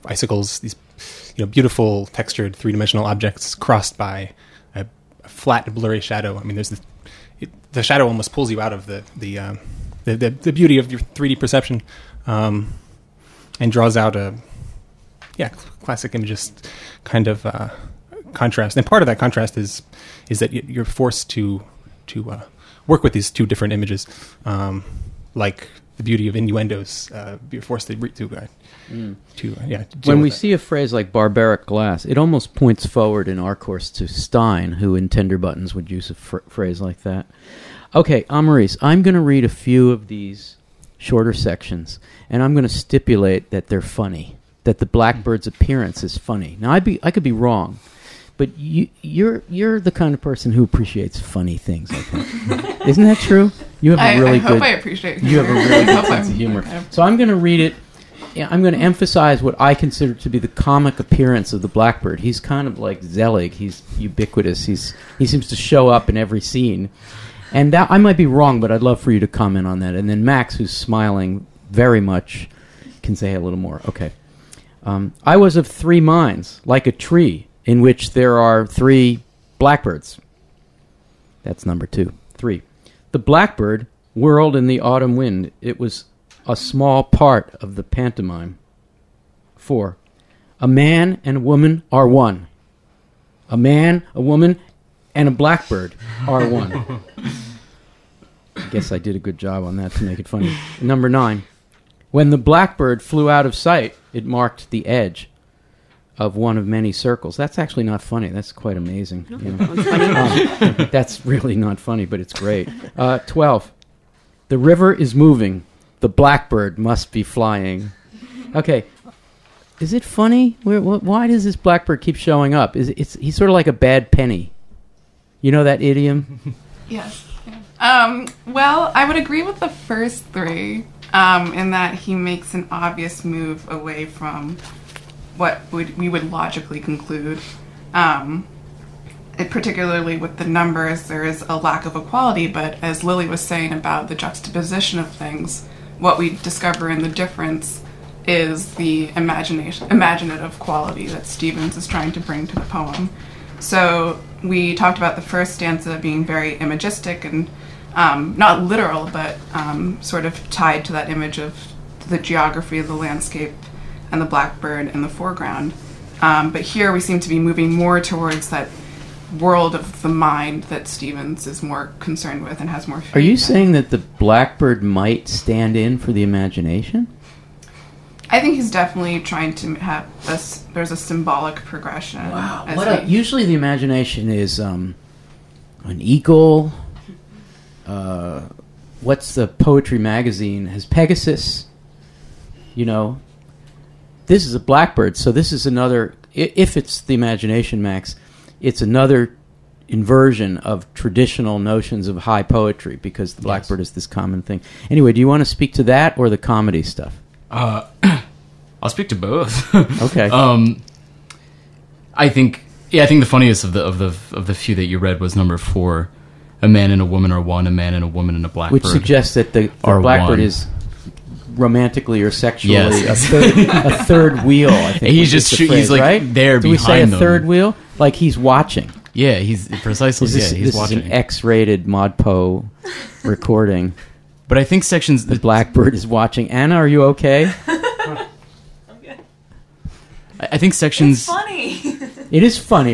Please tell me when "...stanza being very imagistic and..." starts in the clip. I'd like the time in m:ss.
2:35.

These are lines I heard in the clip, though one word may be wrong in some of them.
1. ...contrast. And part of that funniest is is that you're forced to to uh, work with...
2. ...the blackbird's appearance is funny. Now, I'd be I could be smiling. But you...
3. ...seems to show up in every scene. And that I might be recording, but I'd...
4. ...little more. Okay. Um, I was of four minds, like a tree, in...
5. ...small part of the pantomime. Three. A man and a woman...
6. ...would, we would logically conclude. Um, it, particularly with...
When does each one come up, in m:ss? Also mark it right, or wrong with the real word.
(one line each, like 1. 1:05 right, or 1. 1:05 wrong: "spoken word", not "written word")
1. 0:18 wrong: "contrast", not "funniest"
2. 0:44 wrong: "wrong", not "smiling"
3. 1:05 wrong: "wrong", not "recording"
4. 1:13 wrong: "three", not "four"
5. 1:26 wrong: "Four", not "Three"
6. 2:15 right.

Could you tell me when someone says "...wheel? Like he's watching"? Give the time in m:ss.
3:47.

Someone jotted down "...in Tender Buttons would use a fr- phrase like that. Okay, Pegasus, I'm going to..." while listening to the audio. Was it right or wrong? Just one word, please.
wrong.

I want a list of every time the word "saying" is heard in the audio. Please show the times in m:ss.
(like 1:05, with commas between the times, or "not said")
2:23, 2:53.